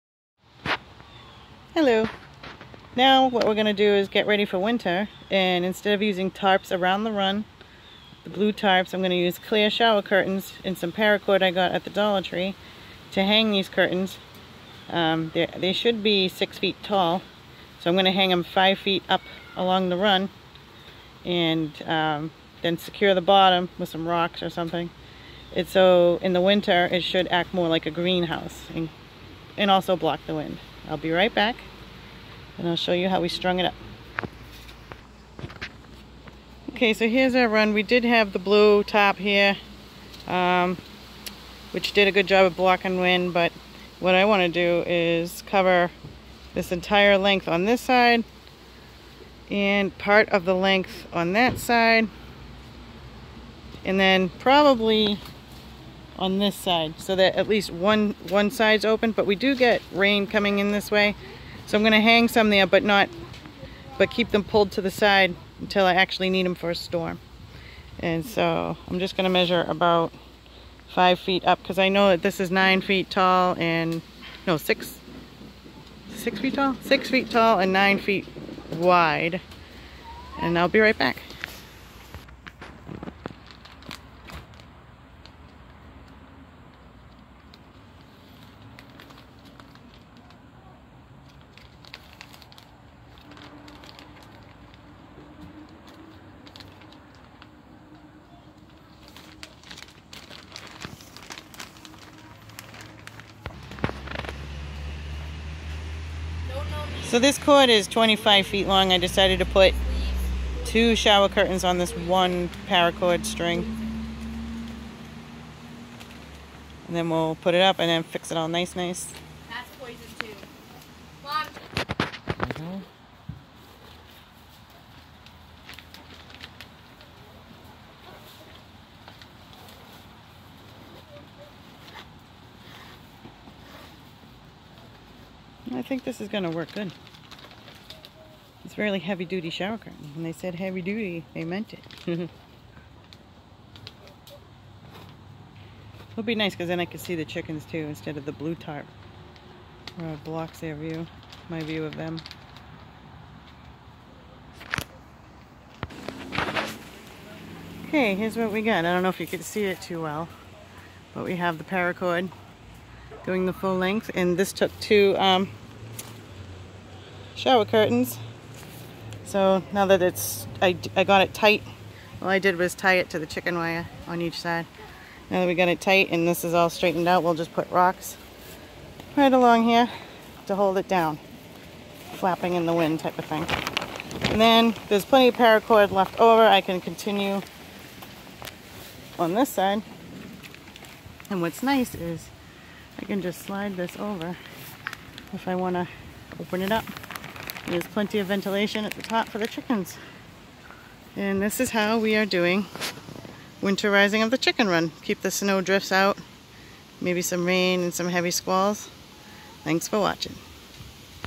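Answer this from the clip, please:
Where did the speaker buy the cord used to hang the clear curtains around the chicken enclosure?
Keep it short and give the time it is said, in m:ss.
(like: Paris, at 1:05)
Dollar Tree, at 0:11.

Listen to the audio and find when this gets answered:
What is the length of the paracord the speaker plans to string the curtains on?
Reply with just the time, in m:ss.
1:47.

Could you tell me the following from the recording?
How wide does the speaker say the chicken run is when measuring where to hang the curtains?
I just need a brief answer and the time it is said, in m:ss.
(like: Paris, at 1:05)
9 feet, at 1:17.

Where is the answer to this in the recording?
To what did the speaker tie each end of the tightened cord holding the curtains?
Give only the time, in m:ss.
2:53.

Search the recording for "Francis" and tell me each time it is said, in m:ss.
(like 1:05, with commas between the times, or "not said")
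not said.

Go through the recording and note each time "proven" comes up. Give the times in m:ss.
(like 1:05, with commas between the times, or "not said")
not said.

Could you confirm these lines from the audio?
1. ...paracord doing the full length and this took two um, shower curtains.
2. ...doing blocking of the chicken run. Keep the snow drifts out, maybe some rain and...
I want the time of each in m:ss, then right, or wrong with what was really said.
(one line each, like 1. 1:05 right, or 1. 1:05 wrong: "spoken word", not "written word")
1. 2:41 right
2. 3:22 wrong: "winterizing", not "blocking".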